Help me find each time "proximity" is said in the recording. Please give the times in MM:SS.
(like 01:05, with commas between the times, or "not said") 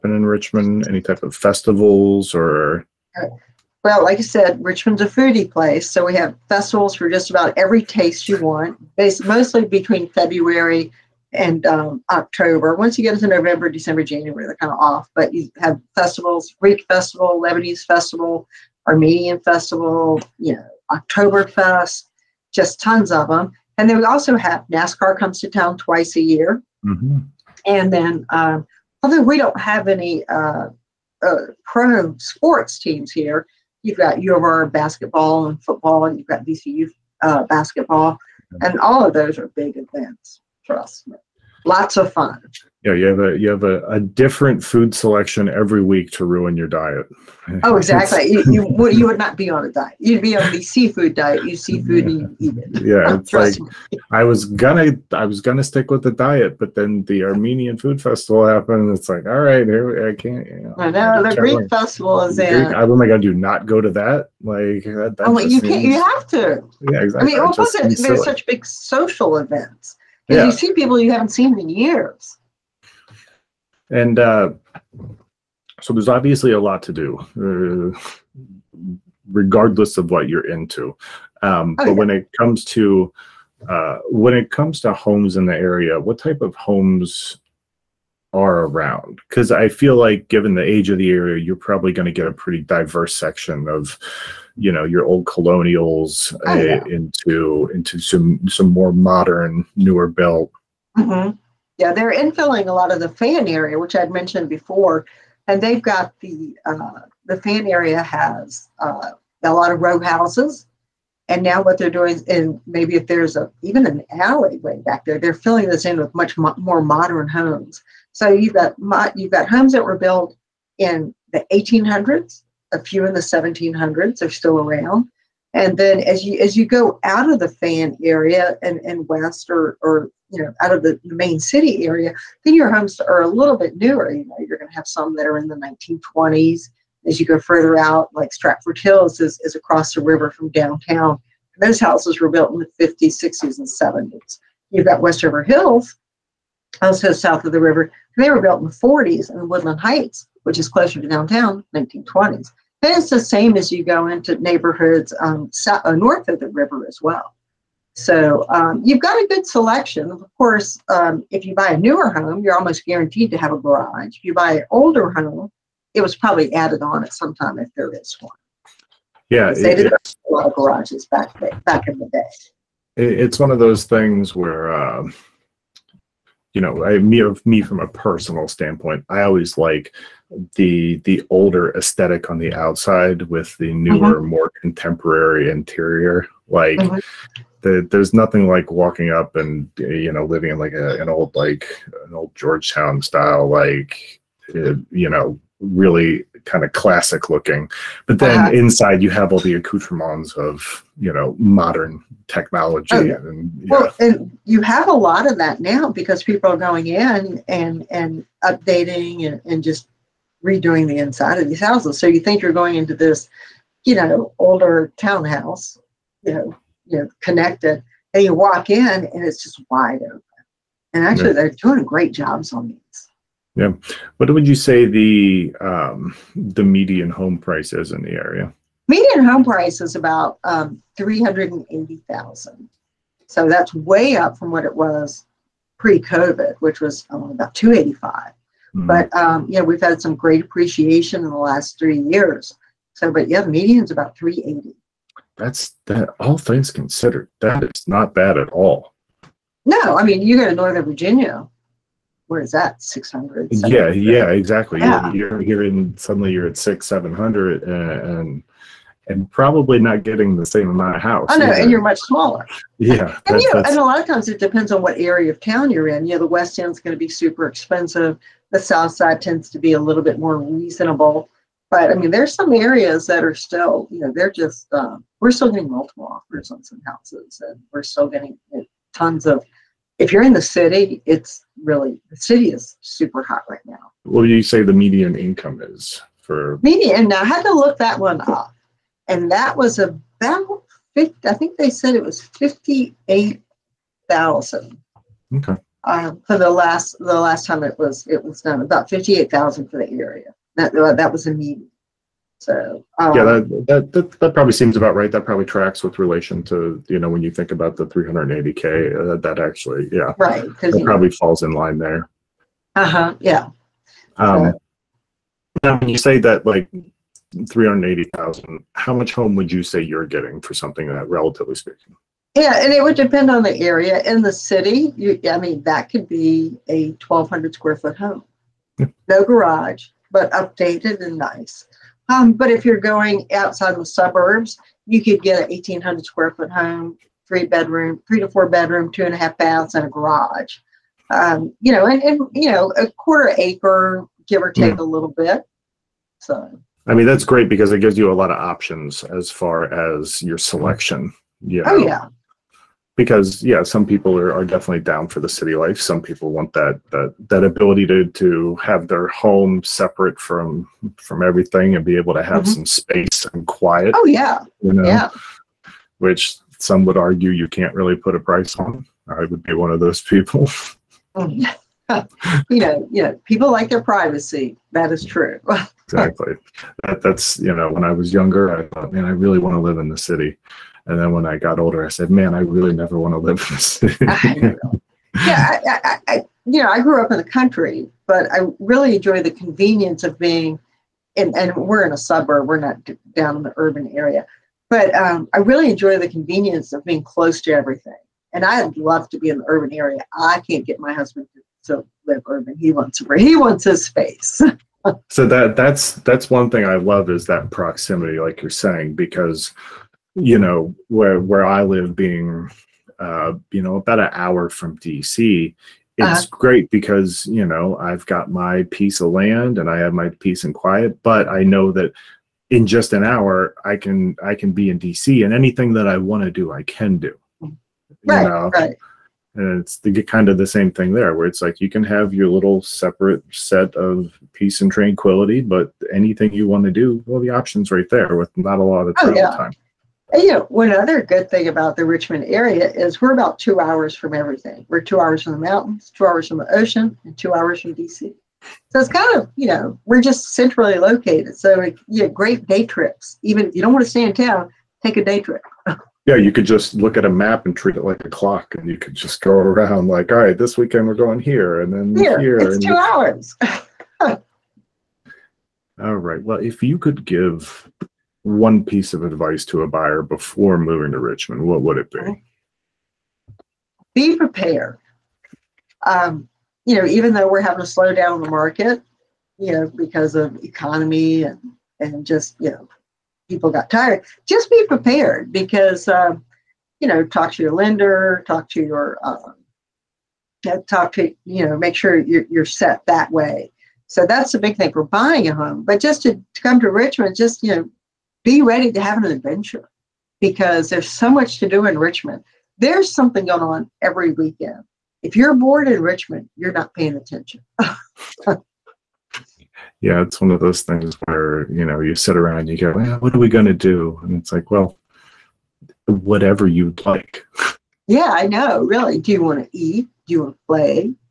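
06:47.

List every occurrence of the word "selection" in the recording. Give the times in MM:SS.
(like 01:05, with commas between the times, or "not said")
00:44, 02:39, 05:50.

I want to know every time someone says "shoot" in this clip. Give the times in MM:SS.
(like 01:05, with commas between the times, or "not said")
not said.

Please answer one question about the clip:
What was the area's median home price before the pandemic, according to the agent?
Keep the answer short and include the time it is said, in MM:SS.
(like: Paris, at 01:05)
285,000, at 03:57.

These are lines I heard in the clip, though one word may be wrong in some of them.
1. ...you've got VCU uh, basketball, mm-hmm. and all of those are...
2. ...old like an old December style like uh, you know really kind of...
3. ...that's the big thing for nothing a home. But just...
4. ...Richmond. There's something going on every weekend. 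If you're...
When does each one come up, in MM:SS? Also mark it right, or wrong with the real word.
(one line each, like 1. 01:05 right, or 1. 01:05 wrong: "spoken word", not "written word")
1. 00:36 right
2. 03:11 wrong: "Georgetown", not "December"
3. 08:14 wrong: "buying", not "nothing"
4. 08:21 right.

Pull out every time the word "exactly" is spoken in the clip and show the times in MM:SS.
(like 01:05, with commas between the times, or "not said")
00:47, 01:07, 04:14, 06:15.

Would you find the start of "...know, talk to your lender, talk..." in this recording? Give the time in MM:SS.
08:06.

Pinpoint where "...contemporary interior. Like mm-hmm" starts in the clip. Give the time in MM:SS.
03:04.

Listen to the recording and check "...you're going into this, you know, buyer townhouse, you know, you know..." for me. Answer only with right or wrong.
wrong.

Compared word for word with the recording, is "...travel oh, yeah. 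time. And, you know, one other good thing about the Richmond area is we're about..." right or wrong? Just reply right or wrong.
right.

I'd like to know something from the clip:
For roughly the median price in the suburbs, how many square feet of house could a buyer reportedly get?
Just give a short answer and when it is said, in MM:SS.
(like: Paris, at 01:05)
1,800, at 05:35.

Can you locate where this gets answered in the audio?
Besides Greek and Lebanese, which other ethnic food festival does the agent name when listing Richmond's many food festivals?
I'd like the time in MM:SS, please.
00:18.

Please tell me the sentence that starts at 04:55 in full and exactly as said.
Um, for the last the last time it was it was done about 58,000 for the area.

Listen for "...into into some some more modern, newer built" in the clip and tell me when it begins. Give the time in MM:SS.
01:36.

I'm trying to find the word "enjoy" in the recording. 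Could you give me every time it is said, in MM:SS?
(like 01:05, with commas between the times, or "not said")
06:28, 06:35.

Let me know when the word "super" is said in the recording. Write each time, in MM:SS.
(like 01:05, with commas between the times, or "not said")
04:27, 04:42.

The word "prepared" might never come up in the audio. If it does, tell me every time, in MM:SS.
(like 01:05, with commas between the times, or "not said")
07:54, 08:04.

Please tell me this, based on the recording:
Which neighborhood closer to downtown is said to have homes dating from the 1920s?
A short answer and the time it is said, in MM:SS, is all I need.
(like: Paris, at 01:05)
Woodland Heights, at 02:29.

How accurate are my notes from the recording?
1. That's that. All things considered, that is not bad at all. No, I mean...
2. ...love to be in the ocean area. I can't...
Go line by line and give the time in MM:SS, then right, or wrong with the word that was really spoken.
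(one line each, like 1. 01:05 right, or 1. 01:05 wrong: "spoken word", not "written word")
1. 04:05 right
2. 06:38 wrong: "urban", not "ocean".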